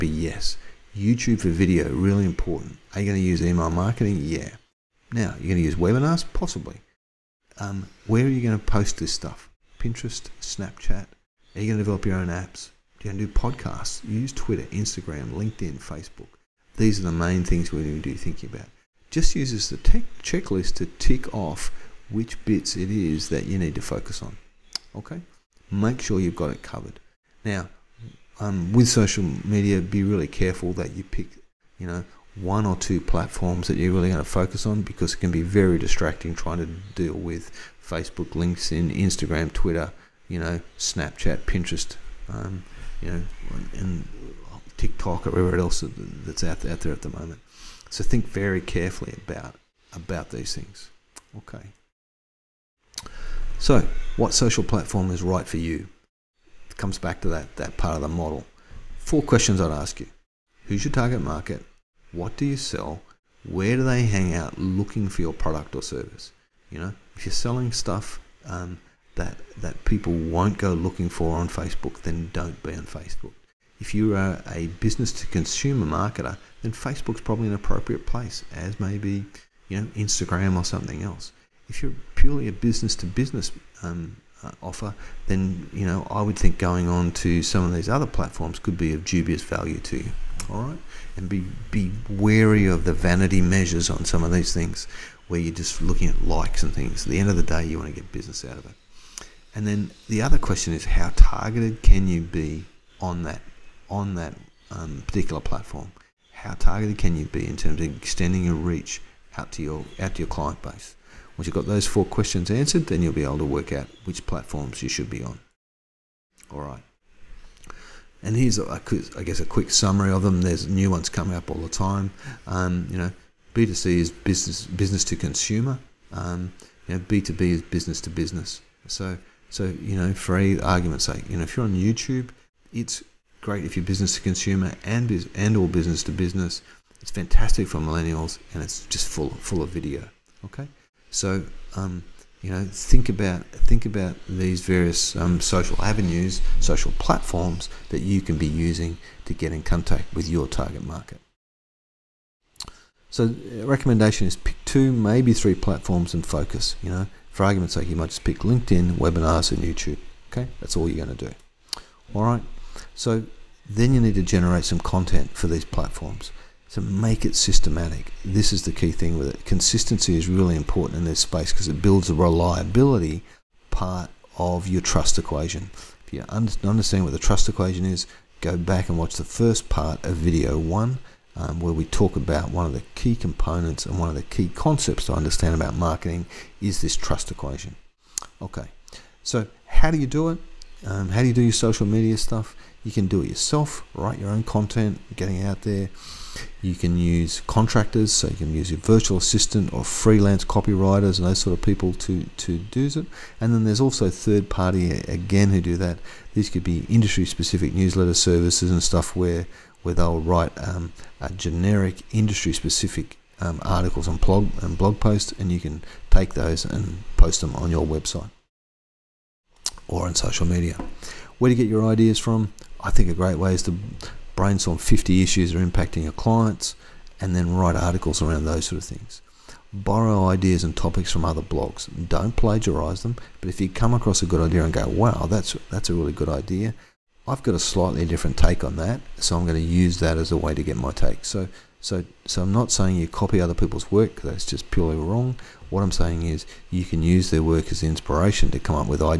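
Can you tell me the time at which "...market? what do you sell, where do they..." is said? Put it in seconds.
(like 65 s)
61 s.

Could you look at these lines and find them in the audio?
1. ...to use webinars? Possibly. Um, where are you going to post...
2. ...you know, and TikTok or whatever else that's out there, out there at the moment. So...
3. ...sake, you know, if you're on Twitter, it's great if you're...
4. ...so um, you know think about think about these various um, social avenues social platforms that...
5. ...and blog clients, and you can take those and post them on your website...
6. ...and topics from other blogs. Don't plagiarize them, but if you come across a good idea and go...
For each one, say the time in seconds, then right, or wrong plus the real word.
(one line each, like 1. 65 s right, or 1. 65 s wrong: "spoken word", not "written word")
1. 5 s right
2. 43 s right
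3. 131 s wrong: "YouTube", not "Twitter"
4. 141 s right
5. 214 s wrong: "posts", not "clients"
6. 230 s right.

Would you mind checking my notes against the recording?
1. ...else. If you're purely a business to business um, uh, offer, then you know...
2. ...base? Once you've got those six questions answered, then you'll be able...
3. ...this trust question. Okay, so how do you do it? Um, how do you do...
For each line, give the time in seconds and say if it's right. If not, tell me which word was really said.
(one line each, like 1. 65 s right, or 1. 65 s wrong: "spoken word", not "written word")
1. 81 s right
2. 110 s wrong: "four", not "six"
3. 186 s wrong: "equation", not "question".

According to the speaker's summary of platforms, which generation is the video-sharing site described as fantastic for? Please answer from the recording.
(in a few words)
Millennials.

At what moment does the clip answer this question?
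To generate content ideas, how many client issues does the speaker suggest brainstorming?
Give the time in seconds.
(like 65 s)
224 s.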